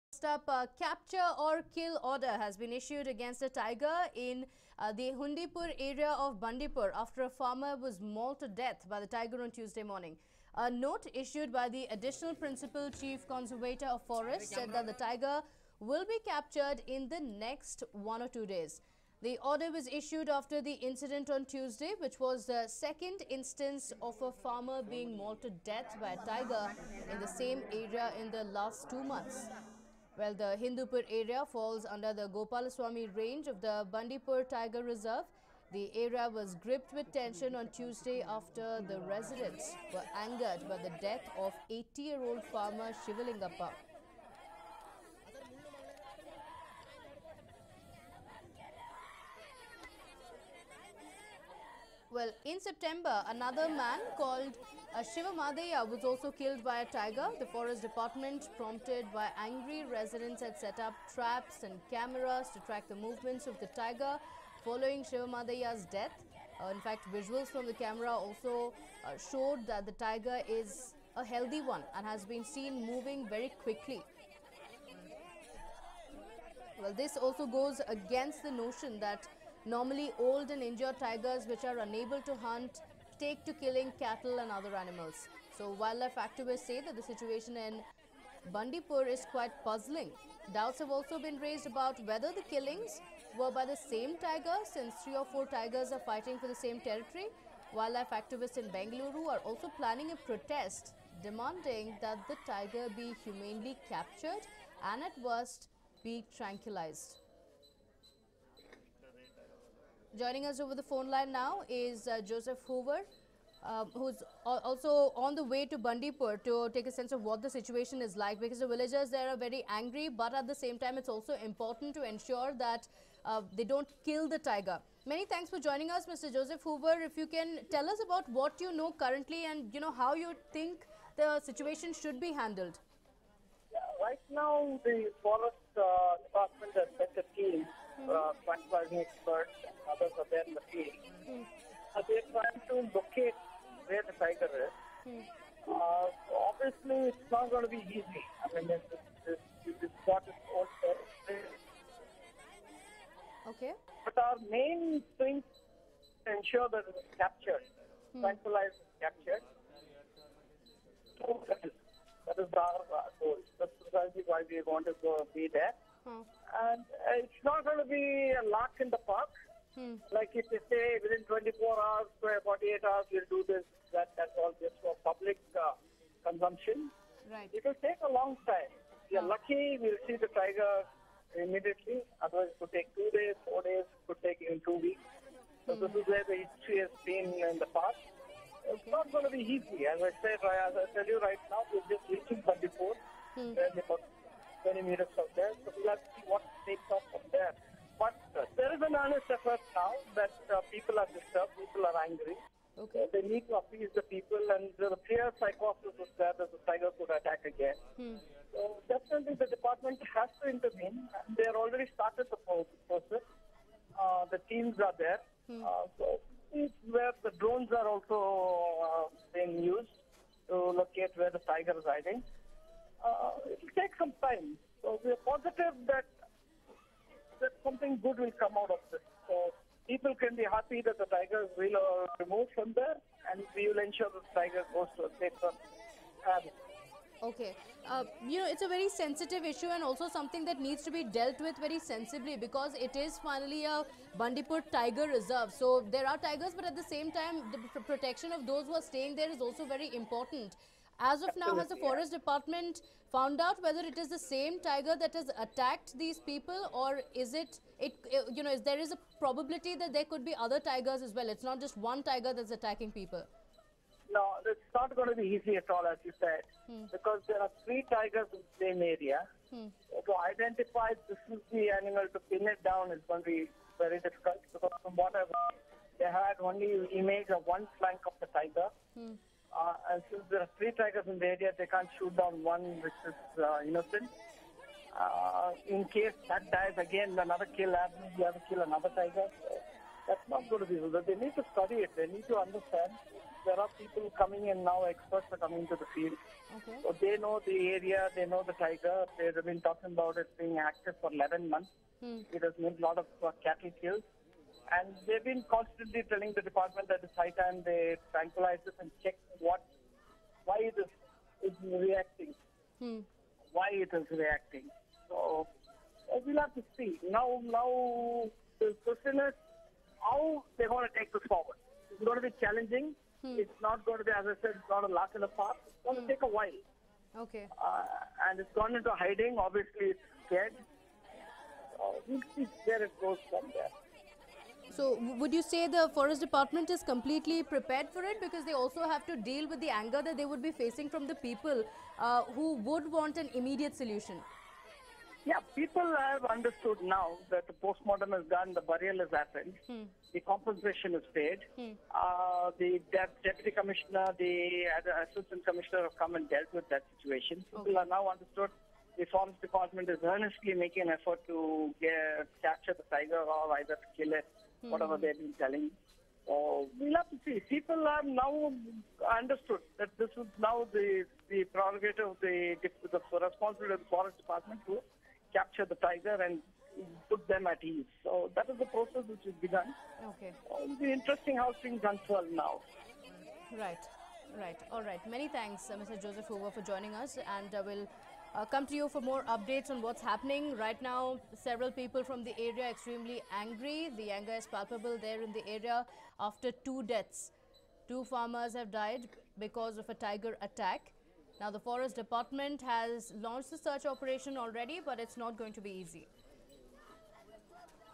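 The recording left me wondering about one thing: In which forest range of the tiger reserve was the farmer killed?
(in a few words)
Gopalaswamy range.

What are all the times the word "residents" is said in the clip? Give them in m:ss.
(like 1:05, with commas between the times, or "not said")
0:39, 0:59.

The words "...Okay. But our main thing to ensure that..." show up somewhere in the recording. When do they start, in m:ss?
2:33.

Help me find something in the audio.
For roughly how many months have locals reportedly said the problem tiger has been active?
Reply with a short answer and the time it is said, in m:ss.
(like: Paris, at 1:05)
11, at 5:01.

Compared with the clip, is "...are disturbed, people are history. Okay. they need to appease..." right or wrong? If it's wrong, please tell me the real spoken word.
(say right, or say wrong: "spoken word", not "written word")
wrong: "angry", not "history".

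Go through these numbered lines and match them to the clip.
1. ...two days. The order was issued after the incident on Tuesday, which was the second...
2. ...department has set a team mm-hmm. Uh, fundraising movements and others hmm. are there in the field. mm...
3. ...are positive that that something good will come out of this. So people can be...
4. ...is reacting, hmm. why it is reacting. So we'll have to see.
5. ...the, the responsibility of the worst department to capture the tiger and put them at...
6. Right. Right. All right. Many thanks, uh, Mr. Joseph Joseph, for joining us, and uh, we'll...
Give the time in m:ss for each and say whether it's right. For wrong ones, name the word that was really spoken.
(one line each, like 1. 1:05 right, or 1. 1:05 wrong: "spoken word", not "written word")
1. 0:18 right
2. 2:16 wrong: "experts", not "movements"
3. 3:45 right
4. 5:11 right
5. 6:12 wrong: "forest", not "worst"
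6. 6:23 wrong: "Hoover", not "Joseph".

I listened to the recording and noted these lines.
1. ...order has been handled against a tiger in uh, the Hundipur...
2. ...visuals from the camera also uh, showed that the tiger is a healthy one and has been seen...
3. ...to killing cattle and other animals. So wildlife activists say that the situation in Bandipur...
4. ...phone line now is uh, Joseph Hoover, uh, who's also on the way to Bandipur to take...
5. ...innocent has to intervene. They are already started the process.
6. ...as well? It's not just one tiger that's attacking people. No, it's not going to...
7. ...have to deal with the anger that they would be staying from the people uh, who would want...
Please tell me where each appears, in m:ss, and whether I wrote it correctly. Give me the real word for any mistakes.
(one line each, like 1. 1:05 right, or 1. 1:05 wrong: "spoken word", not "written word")
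1. 0:02 wrong: "issued", not "handled"
2. 1:07 right
3. 1:23 right
4. 1:50 right
5. 3:29 wrong: "department", not "innocent"
6. 4:21 right
7. 5:38 wrong: "facing", not "staying".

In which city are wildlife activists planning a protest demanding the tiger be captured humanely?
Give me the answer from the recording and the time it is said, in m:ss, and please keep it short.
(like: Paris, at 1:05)
Bengaluru, at 1:38.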